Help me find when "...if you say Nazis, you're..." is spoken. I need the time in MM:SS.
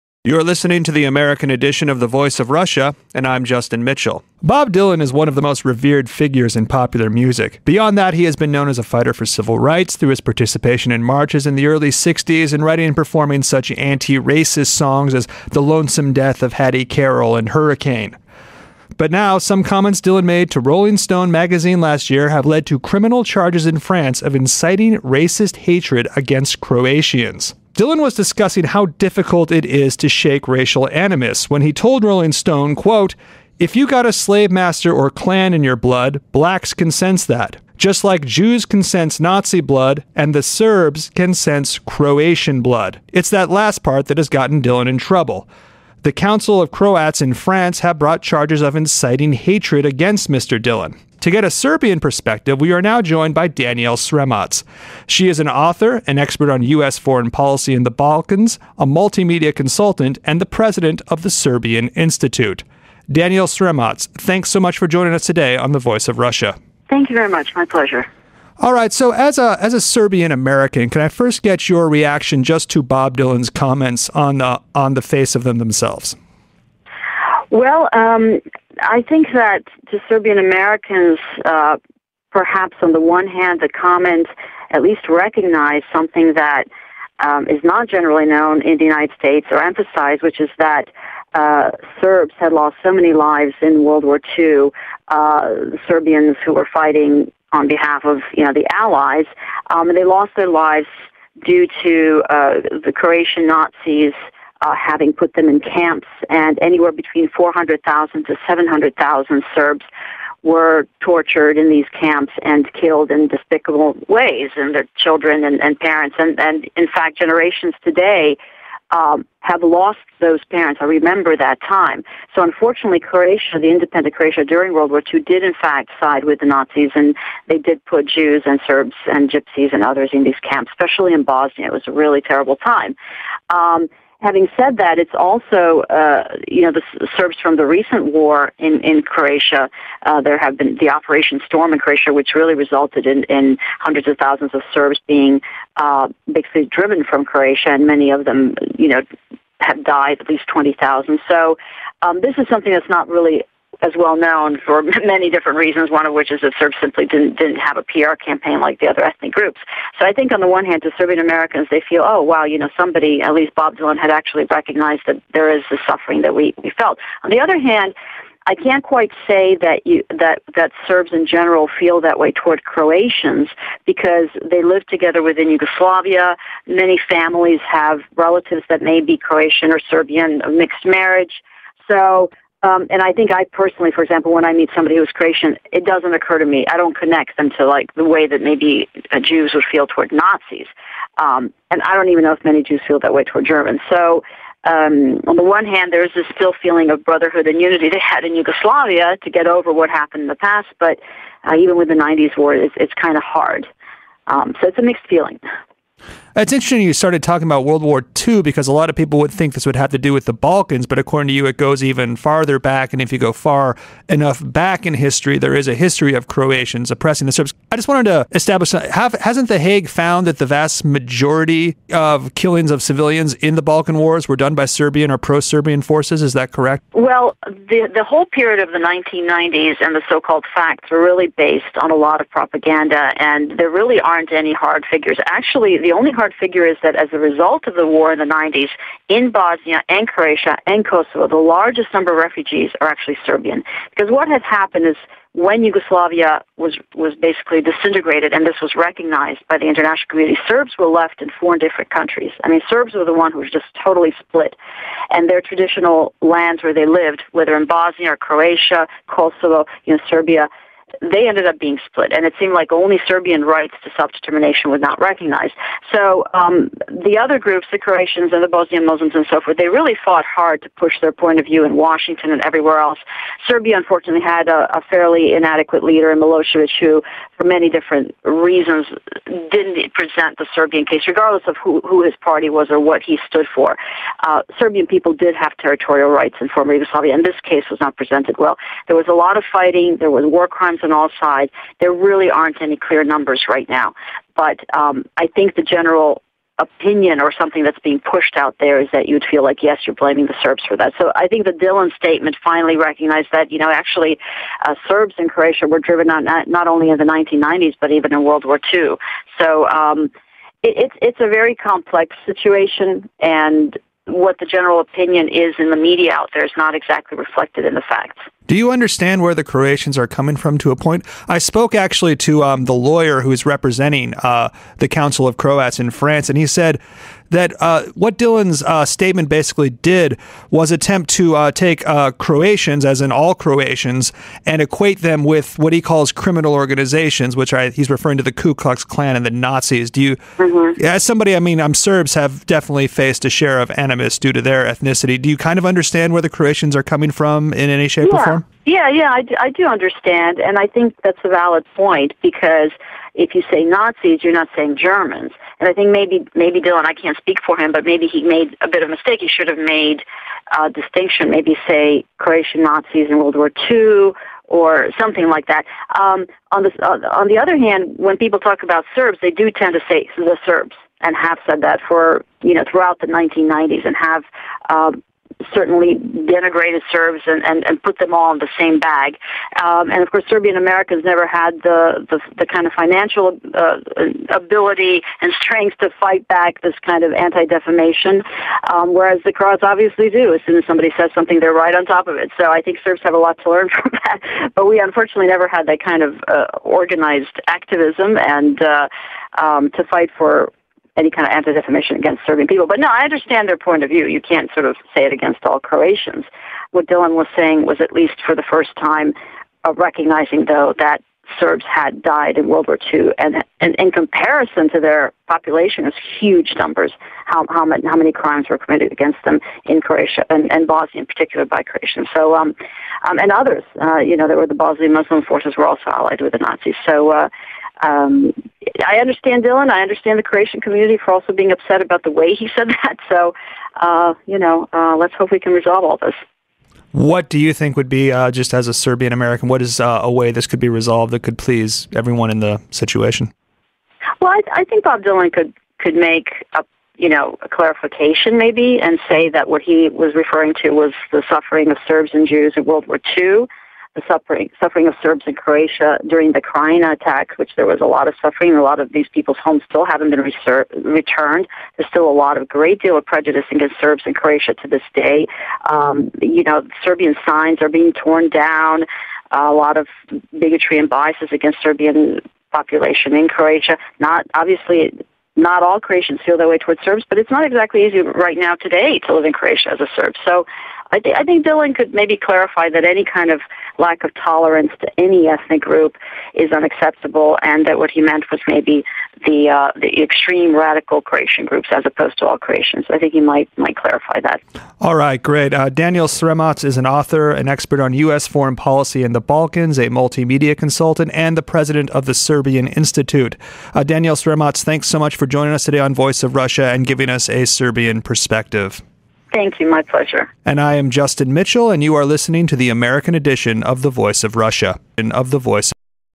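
05:53.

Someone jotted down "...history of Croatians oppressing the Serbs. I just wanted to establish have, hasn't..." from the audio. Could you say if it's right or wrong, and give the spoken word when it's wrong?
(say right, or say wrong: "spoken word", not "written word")
right.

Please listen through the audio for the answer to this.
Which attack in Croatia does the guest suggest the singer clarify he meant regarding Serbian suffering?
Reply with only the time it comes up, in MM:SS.
07:36.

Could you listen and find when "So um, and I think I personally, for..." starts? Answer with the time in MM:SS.
03:01.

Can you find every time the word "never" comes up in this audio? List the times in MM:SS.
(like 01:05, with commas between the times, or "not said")
06:21, 06:35.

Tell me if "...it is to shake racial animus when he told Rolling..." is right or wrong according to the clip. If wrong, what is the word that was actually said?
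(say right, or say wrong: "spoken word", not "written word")
right.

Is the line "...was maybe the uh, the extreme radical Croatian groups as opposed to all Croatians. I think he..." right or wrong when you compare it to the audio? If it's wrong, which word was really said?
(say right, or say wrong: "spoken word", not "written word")
right.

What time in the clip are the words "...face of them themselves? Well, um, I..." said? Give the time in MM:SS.
01:15.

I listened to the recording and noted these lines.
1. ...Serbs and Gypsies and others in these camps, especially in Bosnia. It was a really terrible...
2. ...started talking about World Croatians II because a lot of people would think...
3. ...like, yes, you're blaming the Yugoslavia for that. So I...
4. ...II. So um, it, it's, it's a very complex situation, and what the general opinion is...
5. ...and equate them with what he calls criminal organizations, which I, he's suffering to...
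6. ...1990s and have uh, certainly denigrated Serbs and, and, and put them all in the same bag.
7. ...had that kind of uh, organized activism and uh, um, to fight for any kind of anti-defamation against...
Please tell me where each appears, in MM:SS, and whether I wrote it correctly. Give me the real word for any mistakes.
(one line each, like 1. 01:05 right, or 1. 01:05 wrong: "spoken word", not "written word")
1. 02:08 right
2. 03:26 wrong: "War", not "Croatians"
3. 04:59 wrong: "Serbs", not "Yugoslavia"
4. 05:08 right
5. 05:34 wrong: "referring", not "suffering"
6. 06:13 right
7. 06:35 right.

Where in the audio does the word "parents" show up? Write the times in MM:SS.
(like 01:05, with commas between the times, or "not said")
01:55, 02:00.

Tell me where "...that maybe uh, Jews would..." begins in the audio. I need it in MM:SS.
03:08.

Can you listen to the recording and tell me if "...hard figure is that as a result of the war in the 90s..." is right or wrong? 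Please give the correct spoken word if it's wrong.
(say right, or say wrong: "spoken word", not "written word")
right.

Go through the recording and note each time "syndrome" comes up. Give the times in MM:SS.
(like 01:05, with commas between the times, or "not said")
not said.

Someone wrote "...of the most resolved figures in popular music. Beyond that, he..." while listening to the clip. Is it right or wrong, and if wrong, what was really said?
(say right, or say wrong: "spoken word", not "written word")
wrong: "revered", not "resolved".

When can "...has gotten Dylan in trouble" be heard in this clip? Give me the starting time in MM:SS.
00:44.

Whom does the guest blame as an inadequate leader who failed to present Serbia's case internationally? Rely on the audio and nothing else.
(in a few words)
Milosevic.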